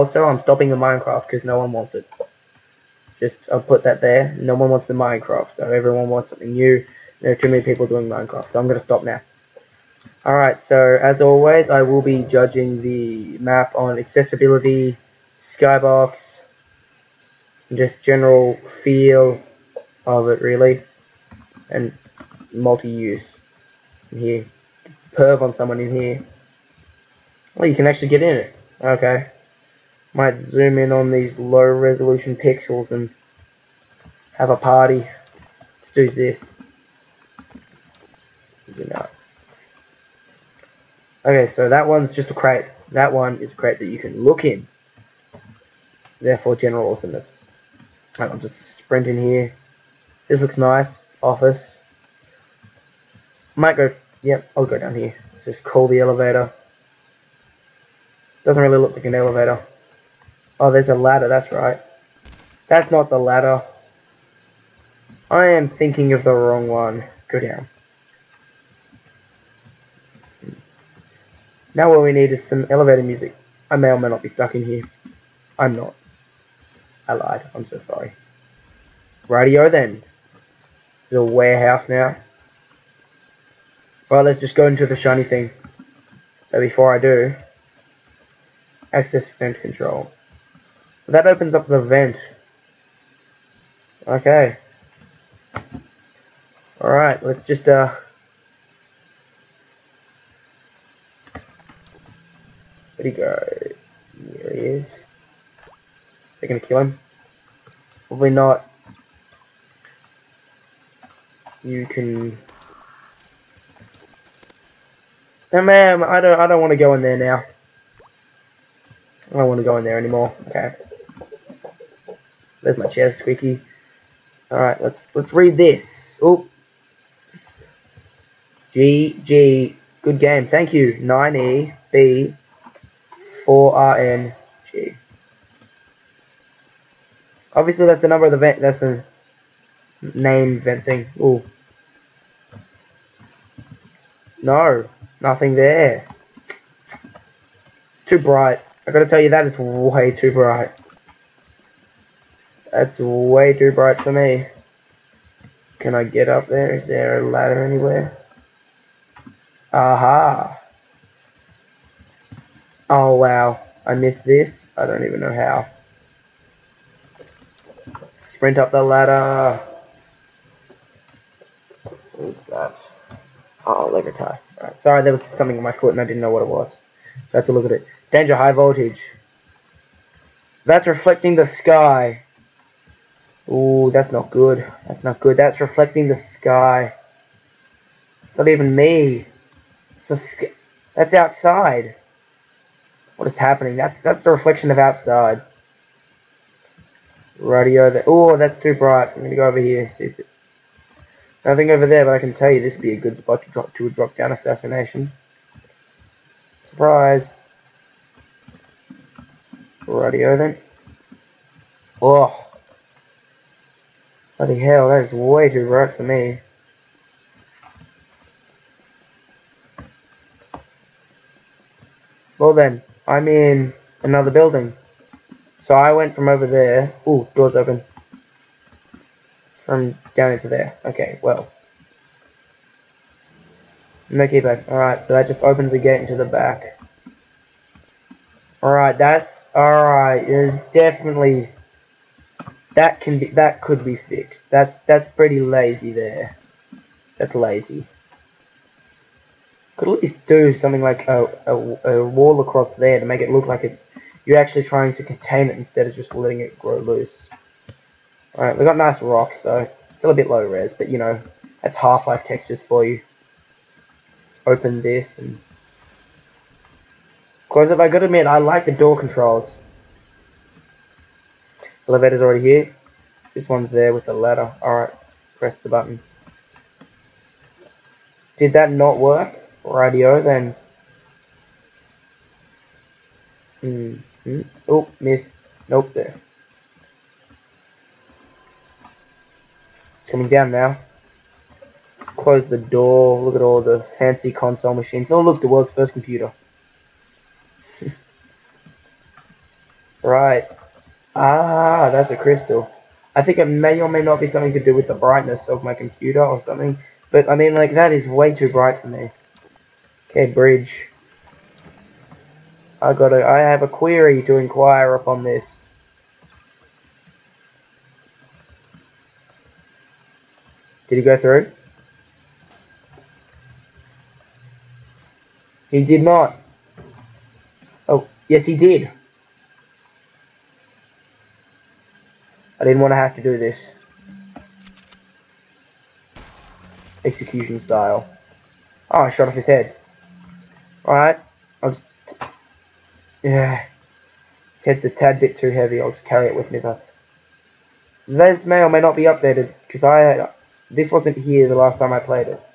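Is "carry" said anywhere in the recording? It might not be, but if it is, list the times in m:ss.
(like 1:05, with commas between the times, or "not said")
5:46.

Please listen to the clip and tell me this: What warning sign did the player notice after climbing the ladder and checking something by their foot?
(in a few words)
Danger high voltage.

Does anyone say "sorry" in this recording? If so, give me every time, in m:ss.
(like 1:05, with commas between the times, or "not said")
1:17, 2:54.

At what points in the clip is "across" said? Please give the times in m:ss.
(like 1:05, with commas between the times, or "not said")
4:12.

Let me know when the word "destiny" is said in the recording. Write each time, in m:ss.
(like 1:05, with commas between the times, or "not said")
not said.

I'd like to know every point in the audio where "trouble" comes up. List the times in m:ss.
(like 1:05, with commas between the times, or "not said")
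not said.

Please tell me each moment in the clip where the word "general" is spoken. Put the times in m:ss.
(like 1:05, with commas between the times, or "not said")
0:18, 0:46.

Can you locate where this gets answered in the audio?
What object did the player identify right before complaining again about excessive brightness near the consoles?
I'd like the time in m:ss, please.
5:02.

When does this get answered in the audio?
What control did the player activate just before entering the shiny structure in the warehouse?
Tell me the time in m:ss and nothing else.
1:28.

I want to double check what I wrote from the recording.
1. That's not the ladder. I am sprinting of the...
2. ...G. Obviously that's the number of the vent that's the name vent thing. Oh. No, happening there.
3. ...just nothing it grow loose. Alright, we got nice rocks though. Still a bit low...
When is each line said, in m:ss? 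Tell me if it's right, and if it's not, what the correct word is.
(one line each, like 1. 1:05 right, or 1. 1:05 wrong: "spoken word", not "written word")
1. 1:02 wrong: "thinking", not "sprinting"
2. 2:14 wrong: "nothing", not "happening"
3. 4:15 wrong: "letting", not "nothing".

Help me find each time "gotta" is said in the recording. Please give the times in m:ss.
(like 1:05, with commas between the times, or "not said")
2:28, 4:27.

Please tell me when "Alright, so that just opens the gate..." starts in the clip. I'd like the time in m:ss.
3:54.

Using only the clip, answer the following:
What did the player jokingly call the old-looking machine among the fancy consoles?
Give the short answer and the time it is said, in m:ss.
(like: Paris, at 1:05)
The world's first computer, at 4:55.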